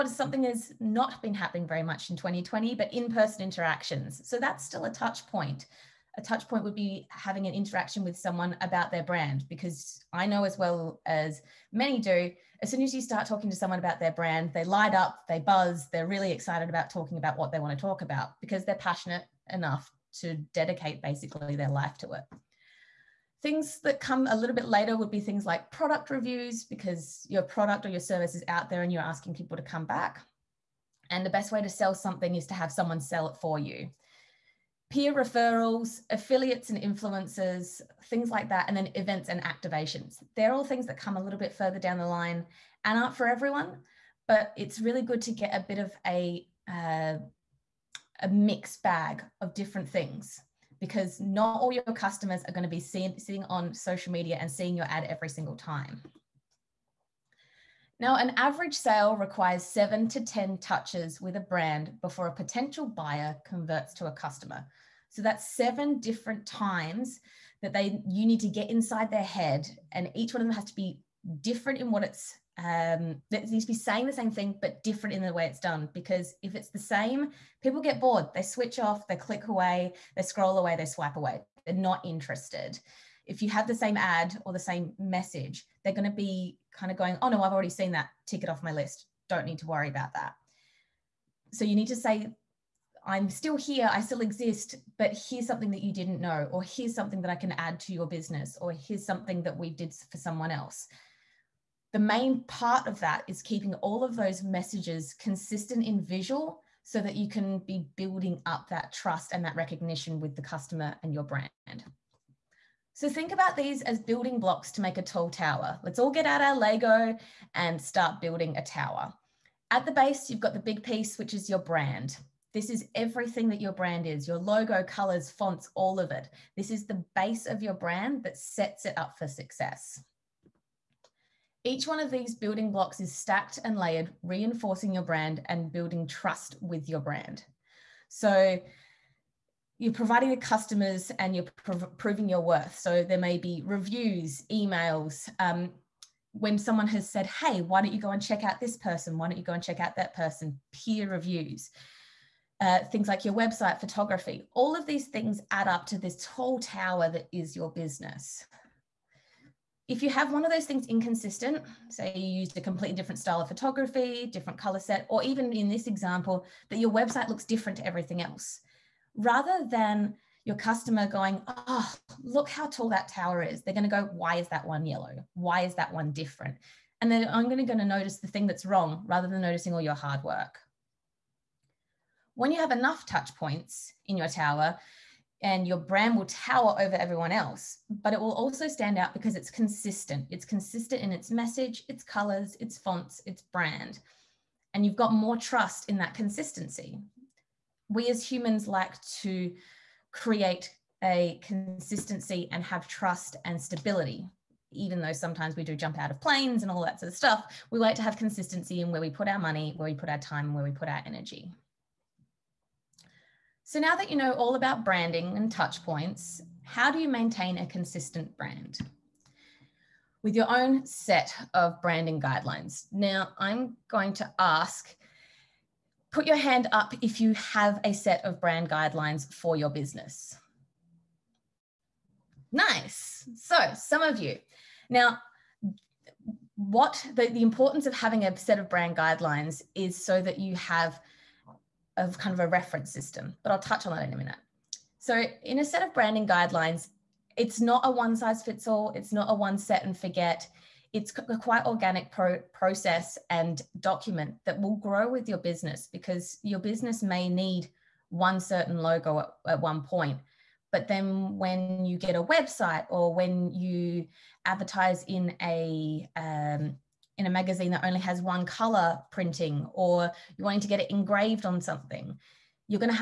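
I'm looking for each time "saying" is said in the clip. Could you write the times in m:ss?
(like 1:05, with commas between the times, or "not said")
1:13.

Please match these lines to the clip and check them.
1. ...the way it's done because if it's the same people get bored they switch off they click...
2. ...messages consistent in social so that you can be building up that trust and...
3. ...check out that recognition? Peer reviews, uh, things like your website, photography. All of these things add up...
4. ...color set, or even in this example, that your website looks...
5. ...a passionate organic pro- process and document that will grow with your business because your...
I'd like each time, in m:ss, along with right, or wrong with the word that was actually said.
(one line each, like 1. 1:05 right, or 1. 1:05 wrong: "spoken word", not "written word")
1. 1:15 right
2. 1:44 wrong: "visual", not "social"
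3. 2:29 wrong: "person", not "recognition"
4. 2:44 right
5. 4:11 wrong: "quite", not "passionate".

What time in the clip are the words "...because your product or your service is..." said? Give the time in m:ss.
0:26.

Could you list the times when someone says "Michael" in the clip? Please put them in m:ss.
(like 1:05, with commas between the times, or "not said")
not said.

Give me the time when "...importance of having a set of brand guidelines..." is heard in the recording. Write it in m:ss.
3:57.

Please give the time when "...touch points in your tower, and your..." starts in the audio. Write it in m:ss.
3:03.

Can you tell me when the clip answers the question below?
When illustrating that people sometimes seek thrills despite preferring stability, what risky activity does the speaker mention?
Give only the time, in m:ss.
3:25.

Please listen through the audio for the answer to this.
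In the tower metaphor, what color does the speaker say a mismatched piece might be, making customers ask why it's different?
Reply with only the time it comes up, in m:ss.
2:54.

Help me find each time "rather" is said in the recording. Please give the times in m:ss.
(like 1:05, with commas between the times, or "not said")
2:49, 2:59.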